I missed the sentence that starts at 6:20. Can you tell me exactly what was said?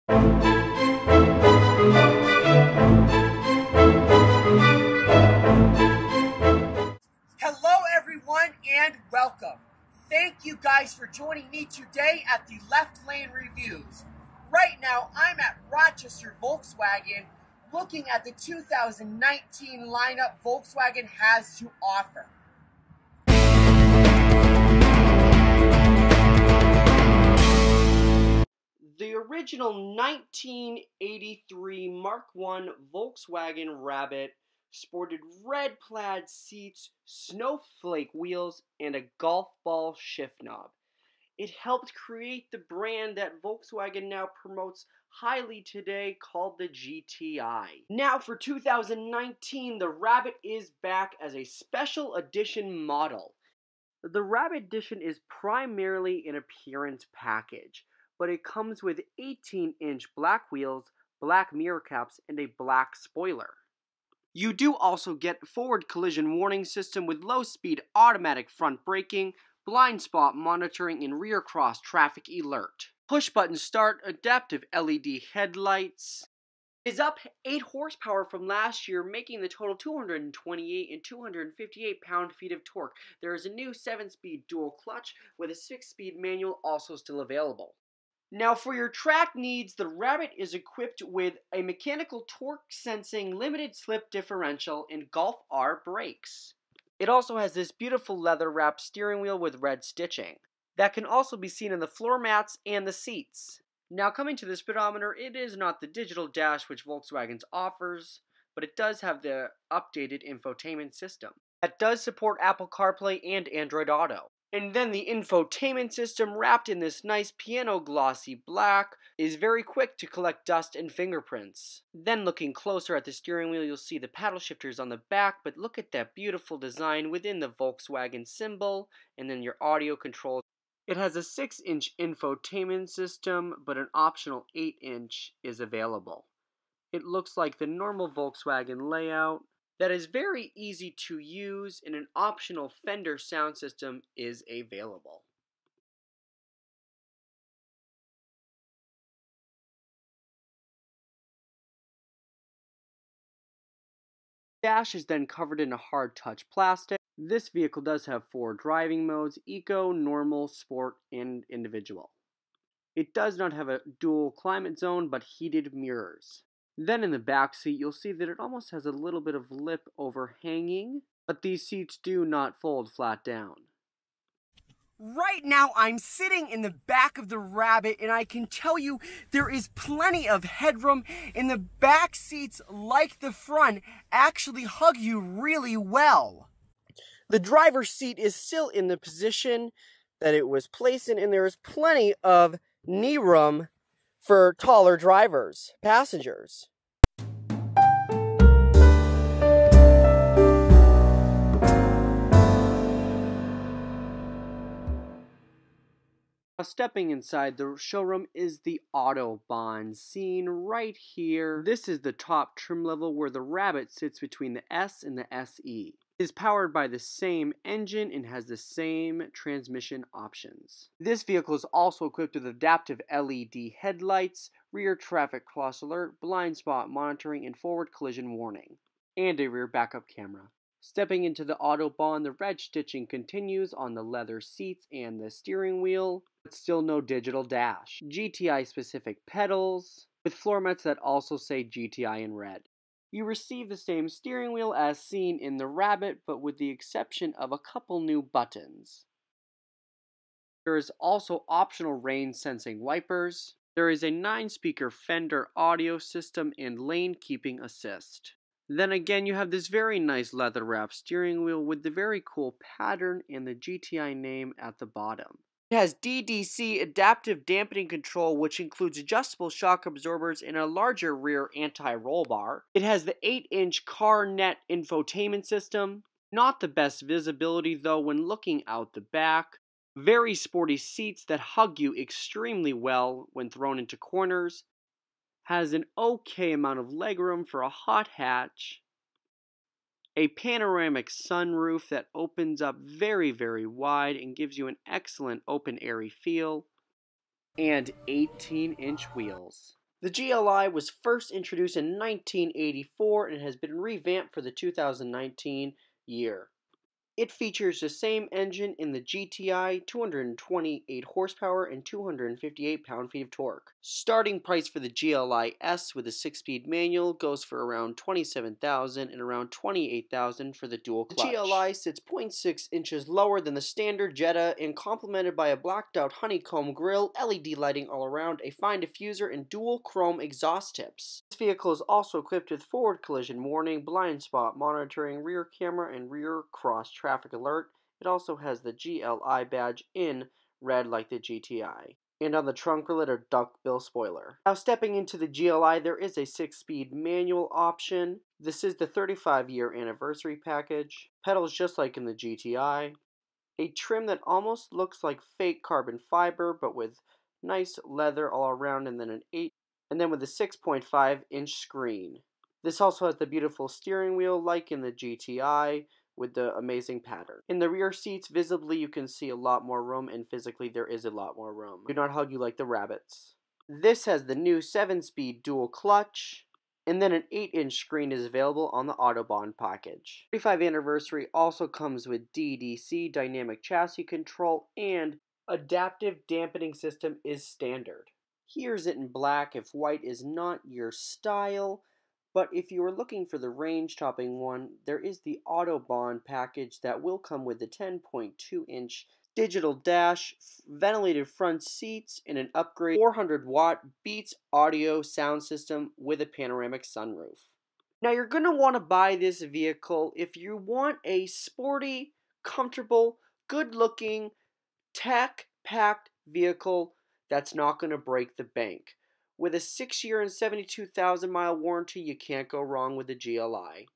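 35 anniversary also comes with DDC, dynamic chassis control, and adaptive dampening system is standard.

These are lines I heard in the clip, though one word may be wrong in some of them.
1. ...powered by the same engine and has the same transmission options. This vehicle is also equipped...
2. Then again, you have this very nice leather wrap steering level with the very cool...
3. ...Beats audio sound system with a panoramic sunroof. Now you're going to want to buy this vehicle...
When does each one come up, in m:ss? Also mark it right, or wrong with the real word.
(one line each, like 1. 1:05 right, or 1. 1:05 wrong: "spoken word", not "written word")
1. 3:36 right
2. 4:18 wrong: "wheel", not "level"
3. 6:44 right.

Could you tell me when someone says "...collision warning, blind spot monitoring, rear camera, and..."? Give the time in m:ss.
5:33.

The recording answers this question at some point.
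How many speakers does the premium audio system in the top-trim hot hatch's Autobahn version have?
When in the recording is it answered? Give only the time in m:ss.
4:14.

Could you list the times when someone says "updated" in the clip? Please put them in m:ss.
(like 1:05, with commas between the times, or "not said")
1:49.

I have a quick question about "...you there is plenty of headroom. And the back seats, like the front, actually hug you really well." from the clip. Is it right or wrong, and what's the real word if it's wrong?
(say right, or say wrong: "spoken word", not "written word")
right.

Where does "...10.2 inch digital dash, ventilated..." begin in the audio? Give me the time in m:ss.
6:37.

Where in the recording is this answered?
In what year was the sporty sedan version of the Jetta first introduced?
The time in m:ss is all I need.
5:01.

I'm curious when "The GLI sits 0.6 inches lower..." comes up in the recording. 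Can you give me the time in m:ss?
5:21.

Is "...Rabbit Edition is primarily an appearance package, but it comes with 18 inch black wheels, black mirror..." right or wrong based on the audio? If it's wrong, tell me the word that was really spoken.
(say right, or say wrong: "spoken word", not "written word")
right.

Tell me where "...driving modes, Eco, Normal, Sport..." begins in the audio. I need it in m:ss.
2:38.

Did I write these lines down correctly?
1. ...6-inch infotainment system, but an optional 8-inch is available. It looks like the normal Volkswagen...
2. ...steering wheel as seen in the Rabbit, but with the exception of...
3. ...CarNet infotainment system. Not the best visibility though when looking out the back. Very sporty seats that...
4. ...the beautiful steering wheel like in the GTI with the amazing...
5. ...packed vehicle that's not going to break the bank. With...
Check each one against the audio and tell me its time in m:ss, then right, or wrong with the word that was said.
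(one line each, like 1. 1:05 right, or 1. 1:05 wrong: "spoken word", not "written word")
1. 2:11 right
2. 4:04 right
3. 4:33 right
4. 6:03 right
5. 6:55 right.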